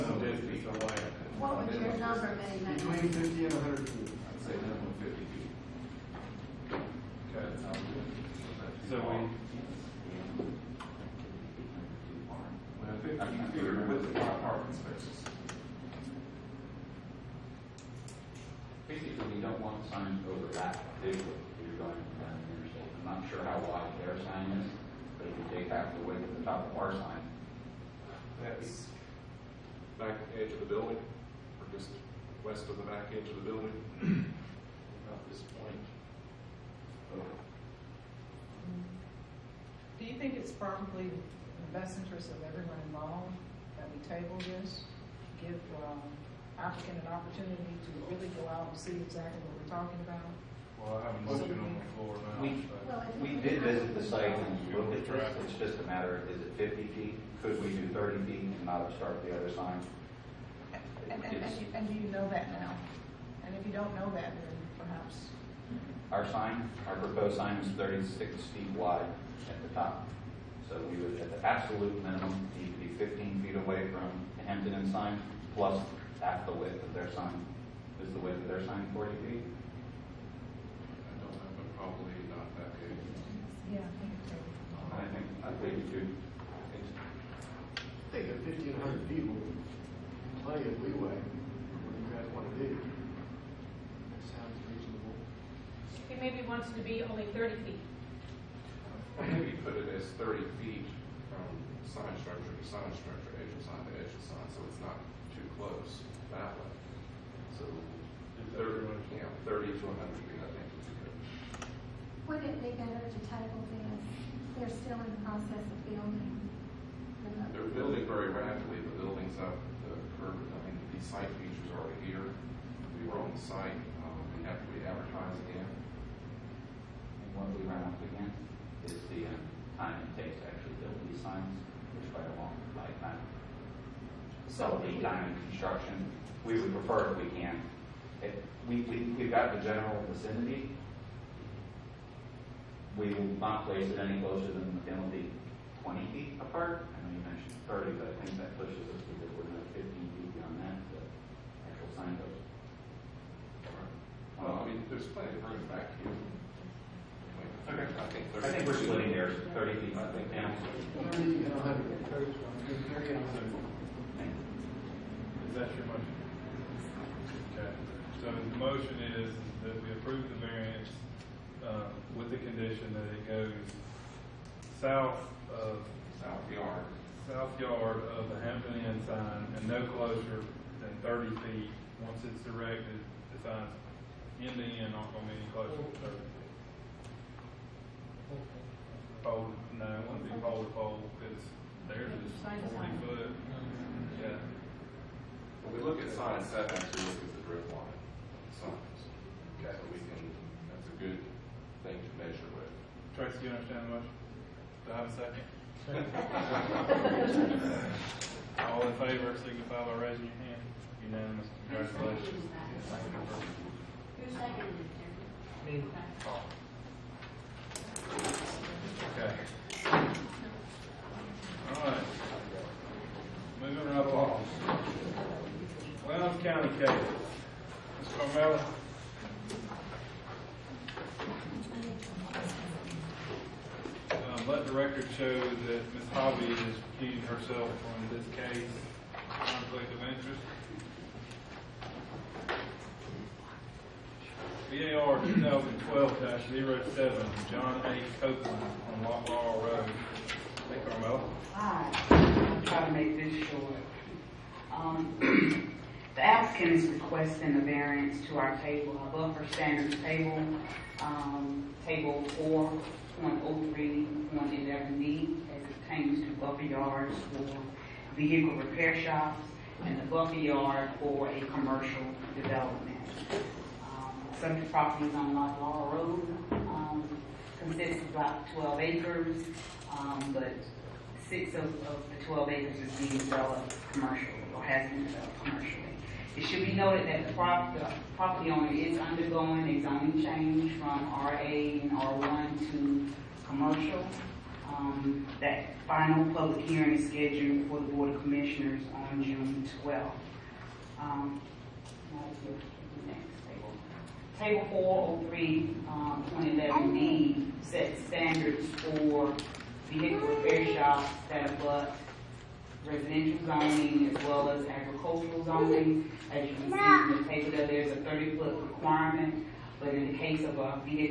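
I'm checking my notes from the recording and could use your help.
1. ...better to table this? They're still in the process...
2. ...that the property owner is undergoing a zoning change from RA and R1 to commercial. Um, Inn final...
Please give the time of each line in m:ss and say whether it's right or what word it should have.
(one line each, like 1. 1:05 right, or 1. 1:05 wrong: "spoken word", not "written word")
1. 1:52 right
2. 4:47 wrong: "That", not "Inn".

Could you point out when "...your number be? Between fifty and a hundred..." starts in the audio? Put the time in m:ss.
0:01.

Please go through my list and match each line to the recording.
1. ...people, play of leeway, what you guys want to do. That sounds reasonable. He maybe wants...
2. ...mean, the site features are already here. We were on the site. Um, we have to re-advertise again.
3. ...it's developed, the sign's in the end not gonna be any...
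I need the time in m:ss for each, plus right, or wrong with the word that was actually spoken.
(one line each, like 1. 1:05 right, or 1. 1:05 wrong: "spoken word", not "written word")
1. 1:29 right
2. 2:00 right
3. 3:02 wrong: "erected", not "developed".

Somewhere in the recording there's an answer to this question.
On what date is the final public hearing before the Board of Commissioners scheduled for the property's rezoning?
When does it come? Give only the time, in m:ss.
4:59.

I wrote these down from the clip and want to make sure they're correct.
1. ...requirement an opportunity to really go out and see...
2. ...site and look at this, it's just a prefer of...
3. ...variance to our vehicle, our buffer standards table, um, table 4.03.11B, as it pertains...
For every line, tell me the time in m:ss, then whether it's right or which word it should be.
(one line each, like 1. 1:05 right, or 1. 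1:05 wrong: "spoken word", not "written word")
1. 0:46 wrong: "applicant", not "requirement"
2. 0:54 wrong: "matter", not "prefer"
3. 4:17 wrong: "table", not "vehicle".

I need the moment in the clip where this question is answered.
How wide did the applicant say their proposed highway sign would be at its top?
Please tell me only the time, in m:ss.
1:07.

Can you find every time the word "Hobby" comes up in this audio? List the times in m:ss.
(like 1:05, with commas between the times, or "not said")
3:56.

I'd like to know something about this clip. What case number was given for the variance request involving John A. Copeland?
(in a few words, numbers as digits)
BAR 2012-07.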